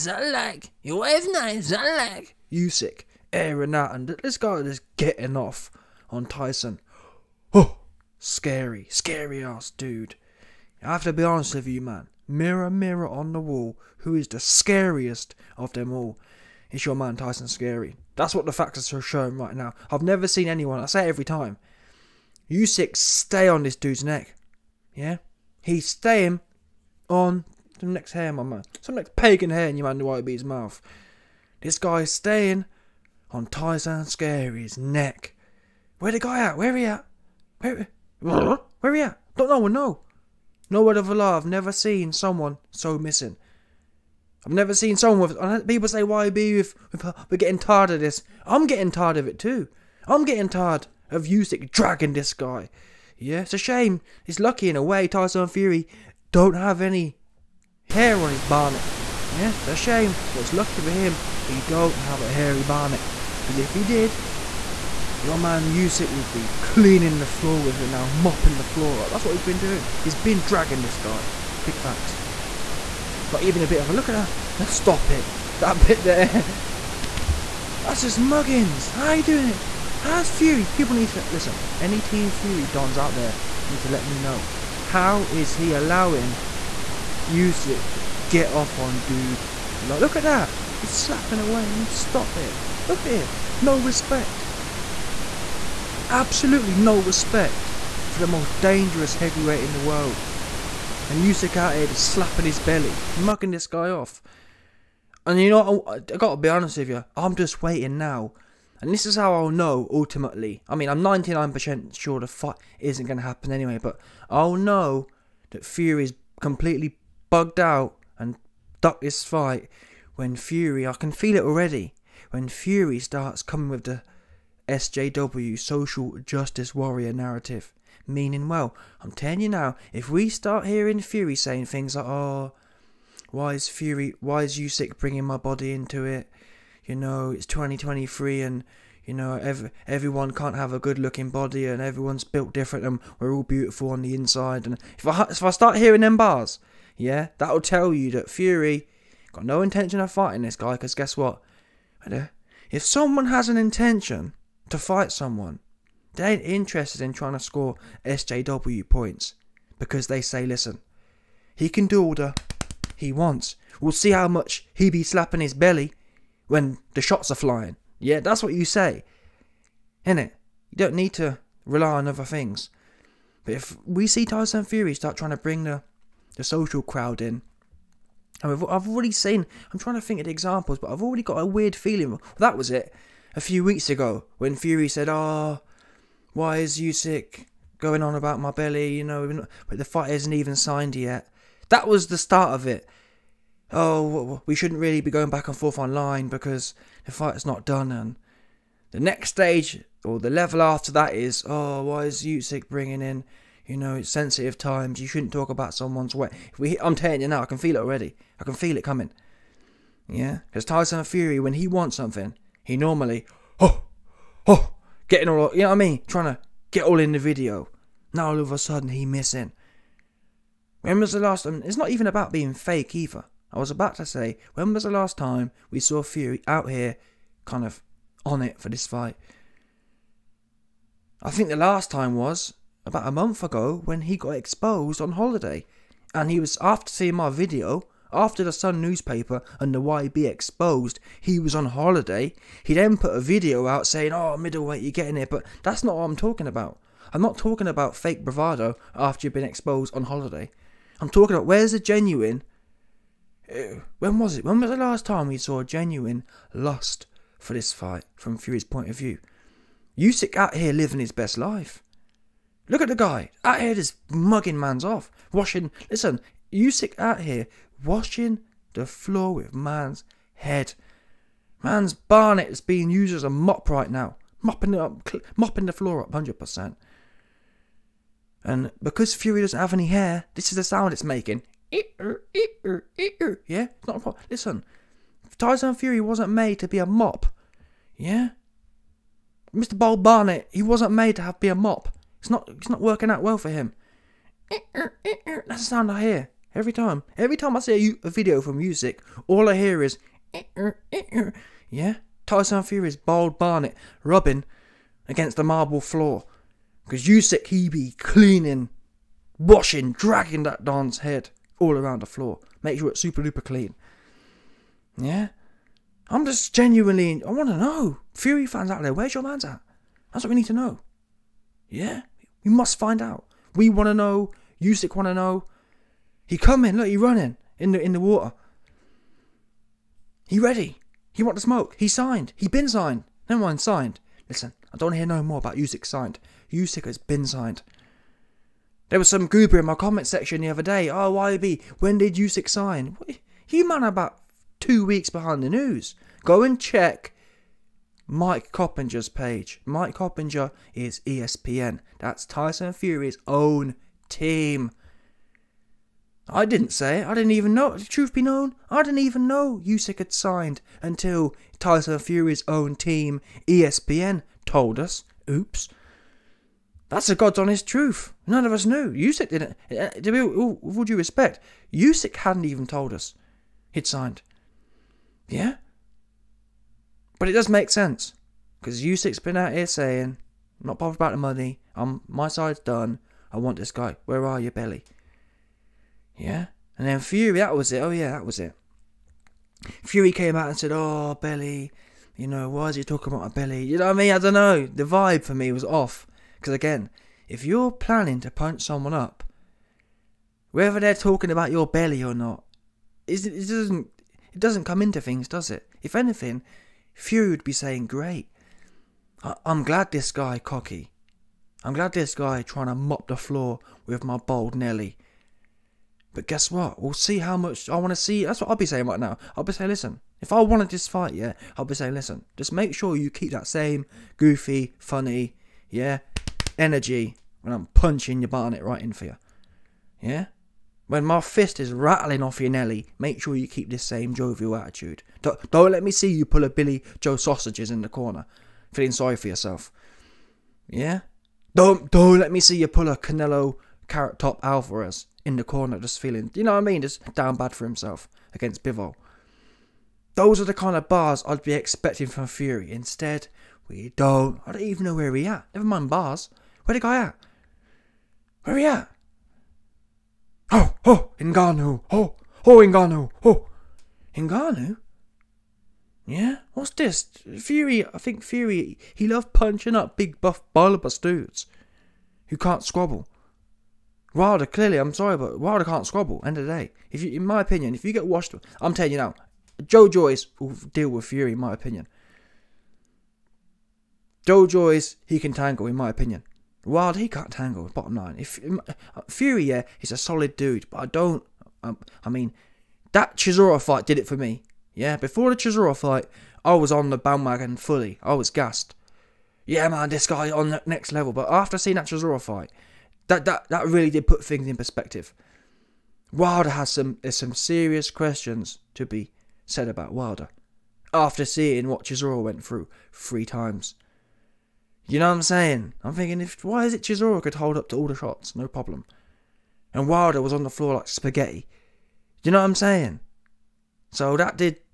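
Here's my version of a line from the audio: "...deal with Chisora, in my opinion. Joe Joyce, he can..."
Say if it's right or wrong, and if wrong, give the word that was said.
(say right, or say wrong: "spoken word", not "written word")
wrong: "Fury", not "Chisora".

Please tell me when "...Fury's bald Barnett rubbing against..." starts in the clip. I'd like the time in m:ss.
5:02.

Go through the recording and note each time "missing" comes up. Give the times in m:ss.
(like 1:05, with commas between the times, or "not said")
0:42, 3:39.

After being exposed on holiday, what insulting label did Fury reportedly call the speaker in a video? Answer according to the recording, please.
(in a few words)
Middleweight.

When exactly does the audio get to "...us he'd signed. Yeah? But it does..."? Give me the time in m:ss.
6:12.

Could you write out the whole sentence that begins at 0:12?
Mirror, mirror on the wall, who is the scariest of them all?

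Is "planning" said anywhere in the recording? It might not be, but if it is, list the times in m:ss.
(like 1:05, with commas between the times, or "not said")
6:37.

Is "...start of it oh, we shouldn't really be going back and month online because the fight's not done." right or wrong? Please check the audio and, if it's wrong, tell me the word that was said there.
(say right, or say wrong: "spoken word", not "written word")
wrong: "forth", not "month".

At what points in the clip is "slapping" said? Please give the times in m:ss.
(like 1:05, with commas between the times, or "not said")
1:30, 1:42, 2:45.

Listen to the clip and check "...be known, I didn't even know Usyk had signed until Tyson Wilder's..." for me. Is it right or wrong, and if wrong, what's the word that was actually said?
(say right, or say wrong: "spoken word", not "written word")
wrong: "Fury", not "Wilder".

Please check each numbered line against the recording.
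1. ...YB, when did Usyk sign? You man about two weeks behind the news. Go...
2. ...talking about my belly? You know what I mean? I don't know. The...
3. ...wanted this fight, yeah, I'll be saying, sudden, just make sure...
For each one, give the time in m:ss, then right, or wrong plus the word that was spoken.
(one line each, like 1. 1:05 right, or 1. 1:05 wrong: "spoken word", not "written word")
1. 5:41 right
2. 6:32 right
3. 7:00 wrong: "listen", not "sudden".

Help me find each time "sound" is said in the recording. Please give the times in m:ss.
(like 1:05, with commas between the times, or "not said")
4:40, 4:55.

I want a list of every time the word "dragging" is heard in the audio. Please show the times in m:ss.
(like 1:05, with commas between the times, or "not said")
0:51, 1:10, 5:09.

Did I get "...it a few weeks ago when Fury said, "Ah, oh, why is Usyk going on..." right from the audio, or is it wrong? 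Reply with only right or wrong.
right.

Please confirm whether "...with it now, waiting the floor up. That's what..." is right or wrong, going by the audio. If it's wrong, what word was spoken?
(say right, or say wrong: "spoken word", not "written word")
wrong: "mopping", not "waiting".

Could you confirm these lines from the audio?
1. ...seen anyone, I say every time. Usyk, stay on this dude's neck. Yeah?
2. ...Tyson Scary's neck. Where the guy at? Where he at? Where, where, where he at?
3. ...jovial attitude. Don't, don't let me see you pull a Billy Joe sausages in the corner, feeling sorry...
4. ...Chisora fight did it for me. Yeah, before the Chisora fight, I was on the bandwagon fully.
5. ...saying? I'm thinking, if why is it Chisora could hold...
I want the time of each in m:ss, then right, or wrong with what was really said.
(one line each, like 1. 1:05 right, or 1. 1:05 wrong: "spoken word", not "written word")
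1. 0:20 right
2. 0:33 right
3. 7:14 right
4. 8:13 right
5. 8:35 right.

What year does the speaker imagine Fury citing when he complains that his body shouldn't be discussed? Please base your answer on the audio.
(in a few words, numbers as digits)
2023.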